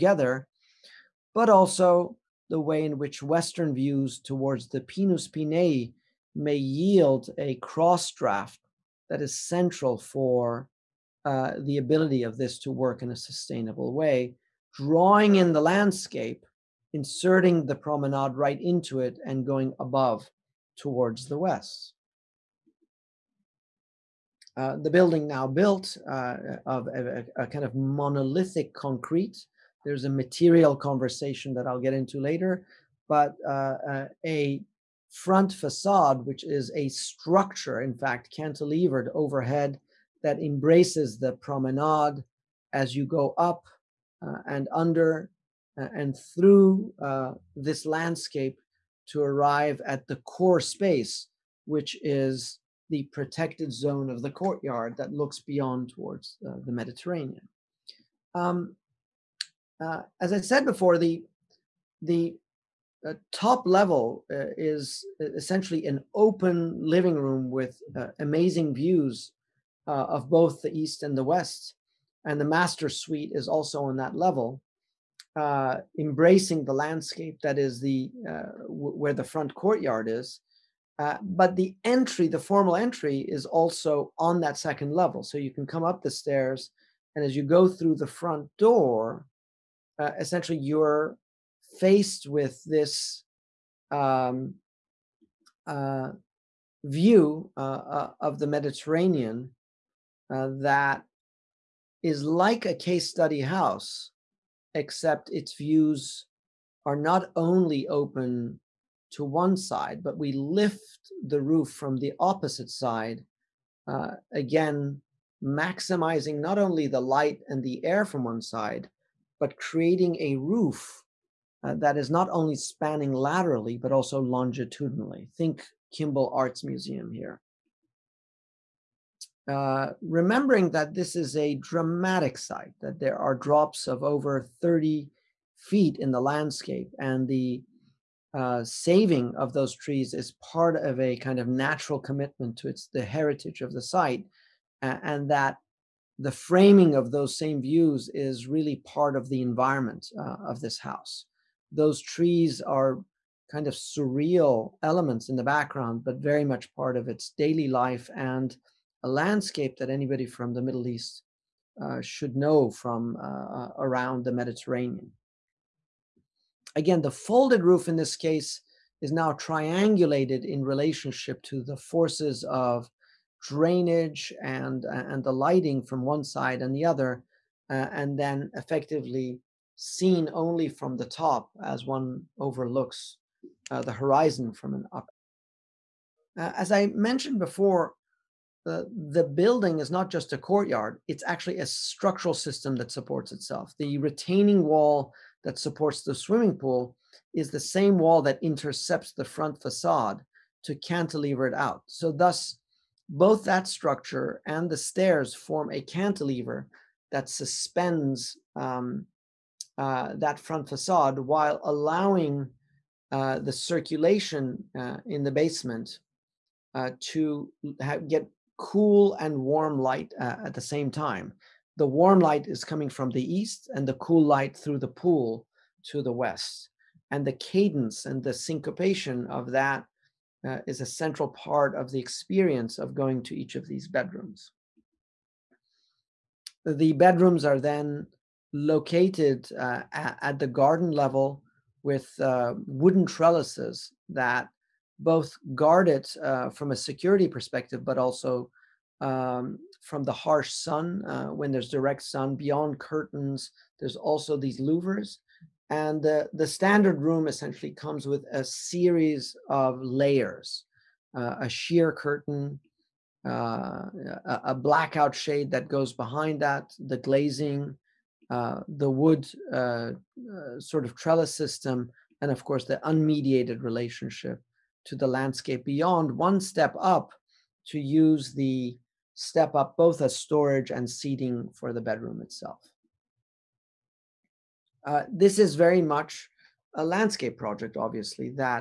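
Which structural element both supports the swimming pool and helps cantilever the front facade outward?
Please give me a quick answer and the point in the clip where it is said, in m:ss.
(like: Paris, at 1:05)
The retaining wall, at 3:13.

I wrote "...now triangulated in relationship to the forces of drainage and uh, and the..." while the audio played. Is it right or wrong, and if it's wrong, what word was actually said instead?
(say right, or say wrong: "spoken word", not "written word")
right.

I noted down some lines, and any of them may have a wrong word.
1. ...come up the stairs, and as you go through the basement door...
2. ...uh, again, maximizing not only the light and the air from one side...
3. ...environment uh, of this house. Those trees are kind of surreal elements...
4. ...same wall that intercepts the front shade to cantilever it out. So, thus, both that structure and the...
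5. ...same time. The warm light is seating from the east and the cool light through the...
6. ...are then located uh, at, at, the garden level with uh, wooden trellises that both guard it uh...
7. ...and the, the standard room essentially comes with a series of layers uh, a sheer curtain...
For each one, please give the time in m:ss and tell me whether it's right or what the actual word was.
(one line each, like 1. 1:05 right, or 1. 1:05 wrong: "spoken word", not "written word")
1. 1:25 wrong: "front", not "basement"
2. 1:53 right
3. 2:29 right
4. 3:17 wrong: "facade", not "shade"
5. 3:40 wrong: "coming", not "seating"
6. 3:57 right
7. 4:15 right.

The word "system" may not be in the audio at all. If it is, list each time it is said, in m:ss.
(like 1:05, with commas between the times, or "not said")
3:12, 4:31.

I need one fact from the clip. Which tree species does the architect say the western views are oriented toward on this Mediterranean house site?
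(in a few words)
Pinus pinea.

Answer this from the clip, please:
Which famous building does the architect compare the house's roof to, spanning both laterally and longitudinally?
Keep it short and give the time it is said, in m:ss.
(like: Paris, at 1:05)
Kimbell Arts Museum, at 2:05.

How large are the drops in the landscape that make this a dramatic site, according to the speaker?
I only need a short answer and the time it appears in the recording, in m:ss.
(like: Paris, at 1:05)
over 30 feet, at 2:14.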